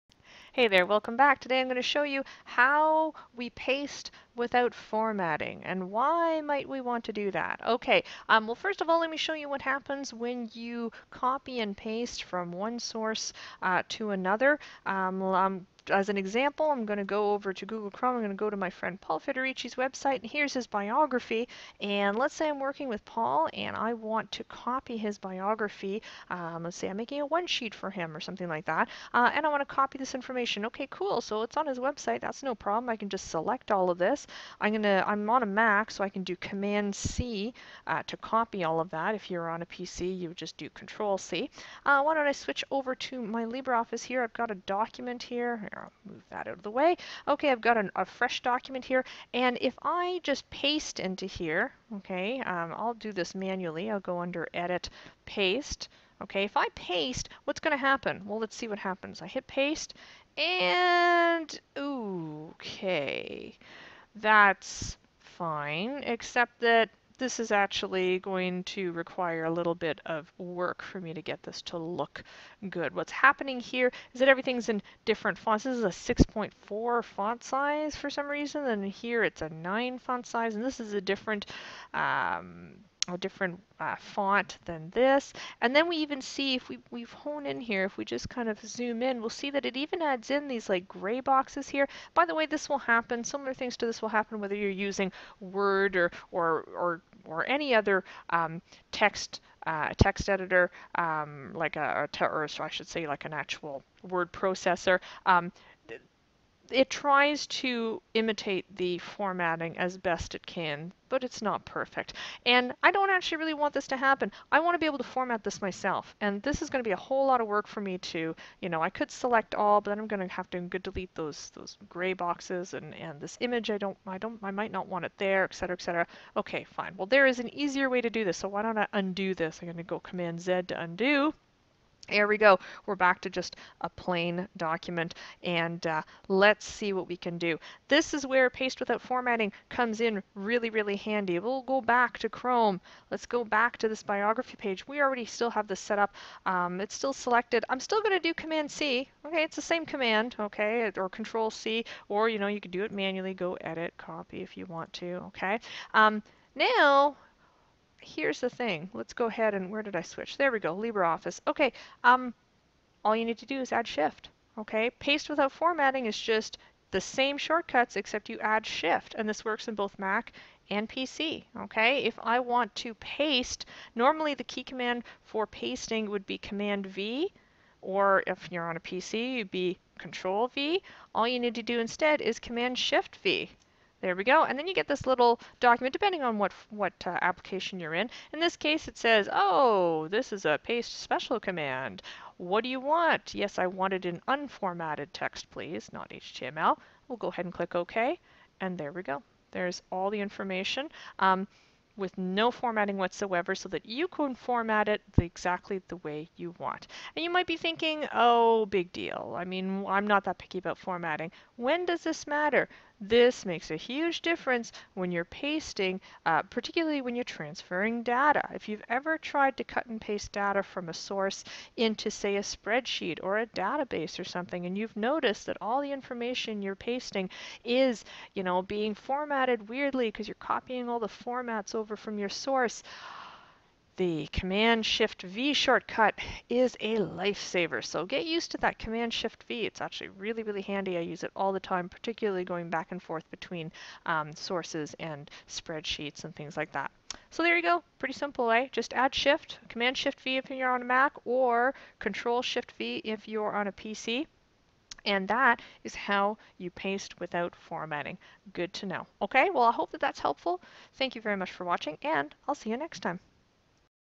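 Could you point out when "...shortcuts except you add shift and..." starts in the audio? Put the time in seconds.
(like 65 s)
167 s.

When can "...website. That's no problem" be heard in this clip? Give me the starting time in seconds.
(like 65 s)
31 s.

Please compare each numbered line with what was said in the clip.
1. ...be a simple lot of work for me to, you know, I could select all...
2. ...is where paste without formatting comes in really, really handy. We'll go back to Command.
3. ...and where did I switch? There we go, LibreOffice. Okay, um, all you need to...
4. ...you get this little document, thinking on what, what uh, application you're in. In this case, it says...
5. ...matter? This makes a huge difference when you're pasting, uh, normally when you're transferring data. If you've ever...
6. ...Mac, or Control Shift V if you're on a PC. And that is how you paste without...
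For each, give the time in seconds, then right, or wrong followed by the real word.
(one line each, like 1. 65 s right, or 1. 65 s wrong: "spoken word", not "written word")
1. 116 s wrong: "whole", not "simple"
2. 138 s wrong: "Chrome", not "Command"
3. 159 s right
4. 184 s wrong: "depending", not "thinking"
5. 212 s wrong: "particularly", not "normally"
6. 250 s right.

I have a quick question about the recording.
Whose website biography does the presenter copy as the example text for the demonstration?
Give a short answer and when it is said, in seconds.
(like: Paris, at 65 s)
Paul Federici, at 19 s.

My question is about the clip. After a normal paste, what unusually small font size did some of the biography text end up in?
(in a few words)
6.4.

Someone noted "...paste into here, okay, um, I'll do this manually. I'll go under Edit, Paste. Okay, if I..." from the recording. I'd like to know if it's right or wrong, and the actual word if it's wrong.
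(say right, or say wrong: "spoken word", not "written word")
right.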